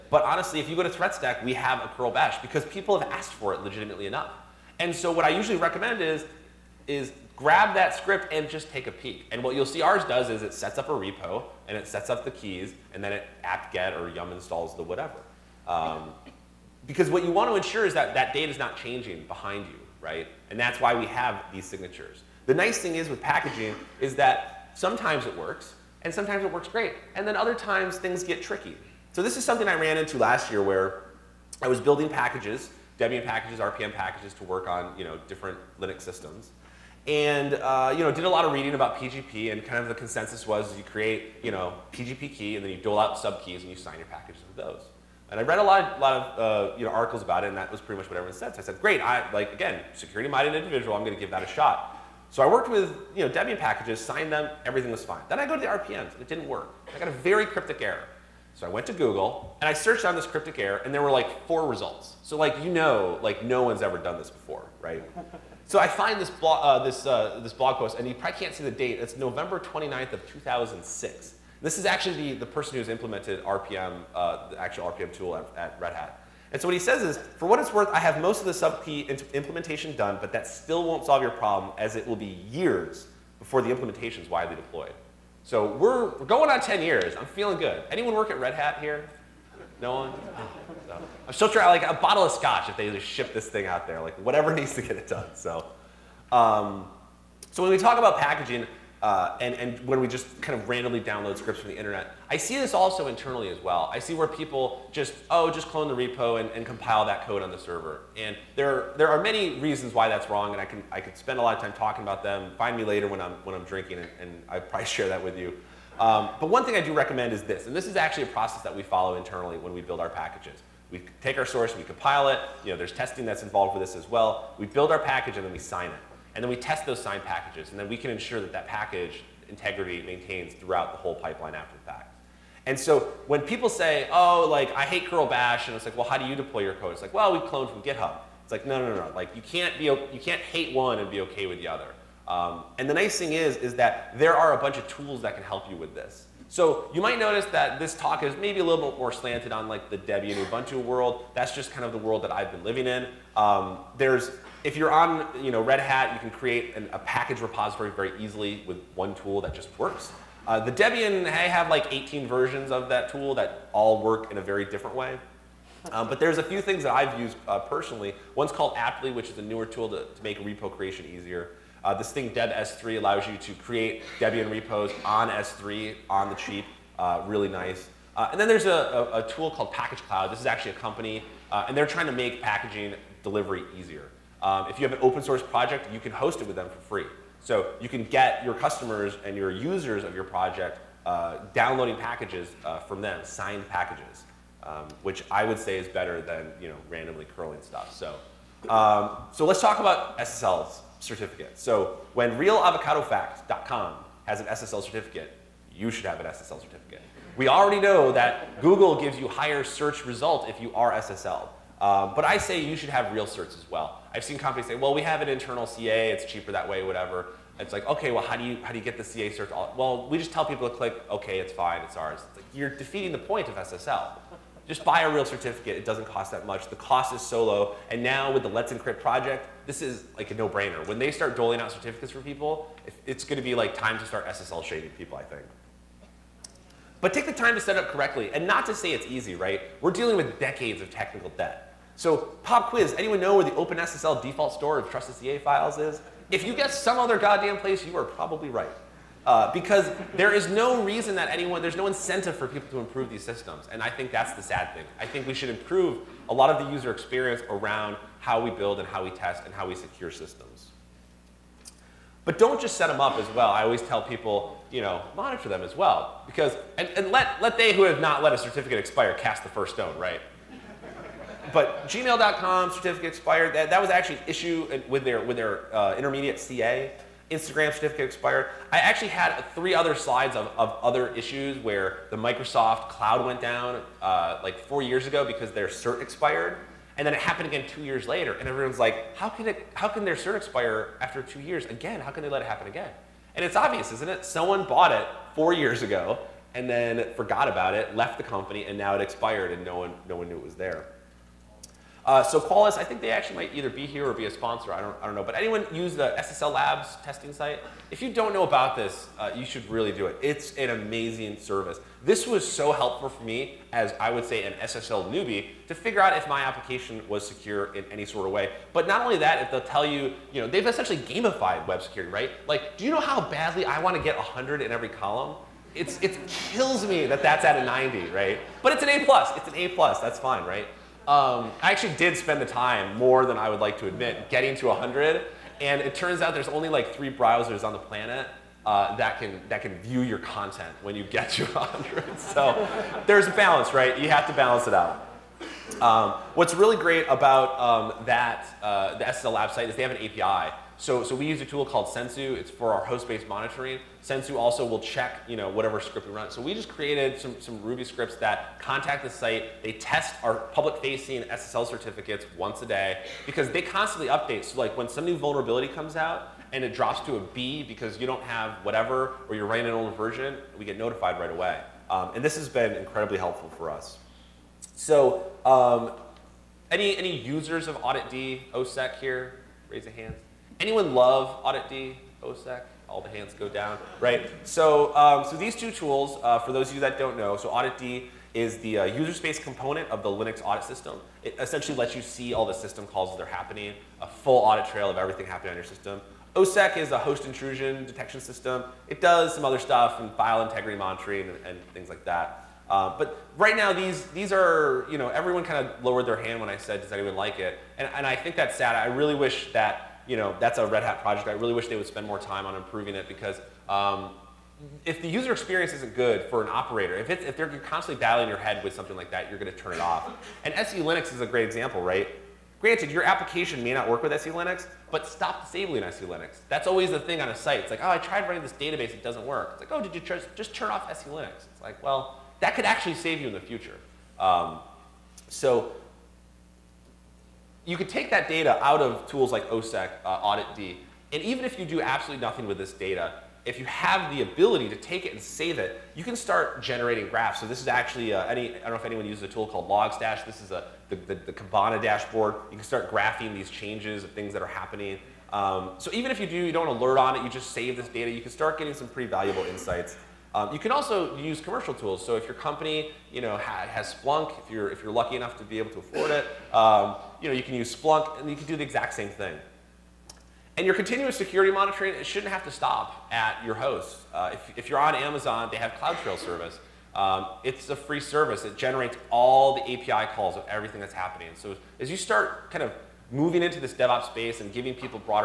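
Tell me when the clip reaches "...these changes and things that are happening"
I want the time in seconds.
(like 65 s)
453 s.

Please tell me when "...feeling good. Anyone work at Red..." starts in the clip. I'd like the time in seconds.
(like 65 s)
87 s.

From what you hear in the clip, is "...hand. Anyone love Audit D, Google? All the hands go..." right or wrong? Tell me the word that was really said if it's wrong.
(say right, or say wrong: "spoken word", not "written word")
wrong: "OSSEC", not "Google".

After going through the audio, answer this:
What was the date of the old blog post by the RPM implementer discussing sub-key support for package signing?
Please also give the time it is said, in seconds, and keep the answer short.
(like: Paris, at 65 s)
November 29th, 2006, at 69 s.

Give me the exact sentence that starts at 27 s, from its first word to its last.
And then other times things get tricky.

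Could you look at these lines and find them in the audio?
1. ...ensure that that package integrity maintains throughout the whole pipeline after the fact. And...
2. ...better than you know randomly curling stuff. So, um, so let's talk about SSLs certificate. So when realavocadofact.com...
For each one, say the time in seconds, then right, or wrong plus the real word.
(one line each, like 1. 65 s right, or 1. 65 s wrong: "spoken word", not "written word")
1. 128 s right
2. 195 s right.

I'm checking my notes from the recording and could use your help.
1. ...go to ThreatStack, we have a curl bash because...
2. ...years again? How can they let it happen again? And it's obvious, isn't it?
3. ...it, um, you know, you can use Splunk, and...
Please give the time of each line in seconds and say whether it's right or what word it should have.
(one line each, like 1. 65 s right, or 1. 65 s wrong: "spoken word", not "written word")
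1. 0 s right
2. 291 s right
3. 466 s right.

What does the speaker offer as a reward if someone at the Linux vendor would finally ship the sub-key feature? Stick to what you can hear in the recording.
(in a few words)
a bottle of scotch.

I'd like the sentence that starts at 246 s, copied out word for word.
If you guess some other goddamn place, you are probably right.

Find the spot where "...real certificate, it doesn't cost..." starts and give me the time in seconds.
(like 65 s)
225 s.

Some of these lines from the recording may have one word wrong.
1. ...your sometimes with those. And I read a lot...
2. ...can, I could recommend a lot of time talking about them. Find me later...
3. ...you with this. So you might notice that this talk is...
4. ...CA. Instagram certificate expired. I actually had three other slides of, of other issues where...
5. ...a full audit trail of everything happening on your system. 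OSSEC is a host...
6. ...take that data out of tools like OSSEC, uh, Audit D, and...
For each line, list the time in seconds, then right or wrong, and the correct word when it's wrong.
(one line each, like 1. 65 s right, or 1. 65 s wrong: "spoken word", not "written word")
1. 43 s wrong: "packages", not "sometimes"
2. 110 s wrong: "spend", not "recommend"
3. 145 s right
4. 276 s right
5. 394 s right
6. 437 s right.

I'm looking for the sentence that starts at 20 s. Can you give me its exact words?
And that's why we have these signatures.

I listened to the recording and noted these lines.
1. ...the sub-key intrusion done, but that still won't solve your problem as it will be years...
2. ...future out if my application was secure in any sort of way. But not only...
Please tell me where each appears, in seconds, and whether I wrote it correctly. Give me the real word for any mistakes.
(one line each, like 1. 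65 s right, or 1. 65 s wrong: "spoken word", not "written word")
1. 78 s wrong: "implementation", not "intrusion"
2. 315 s wrong: "figure", not "future".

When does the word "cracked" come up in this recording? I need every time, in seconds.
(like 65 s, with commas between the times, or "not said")
not said.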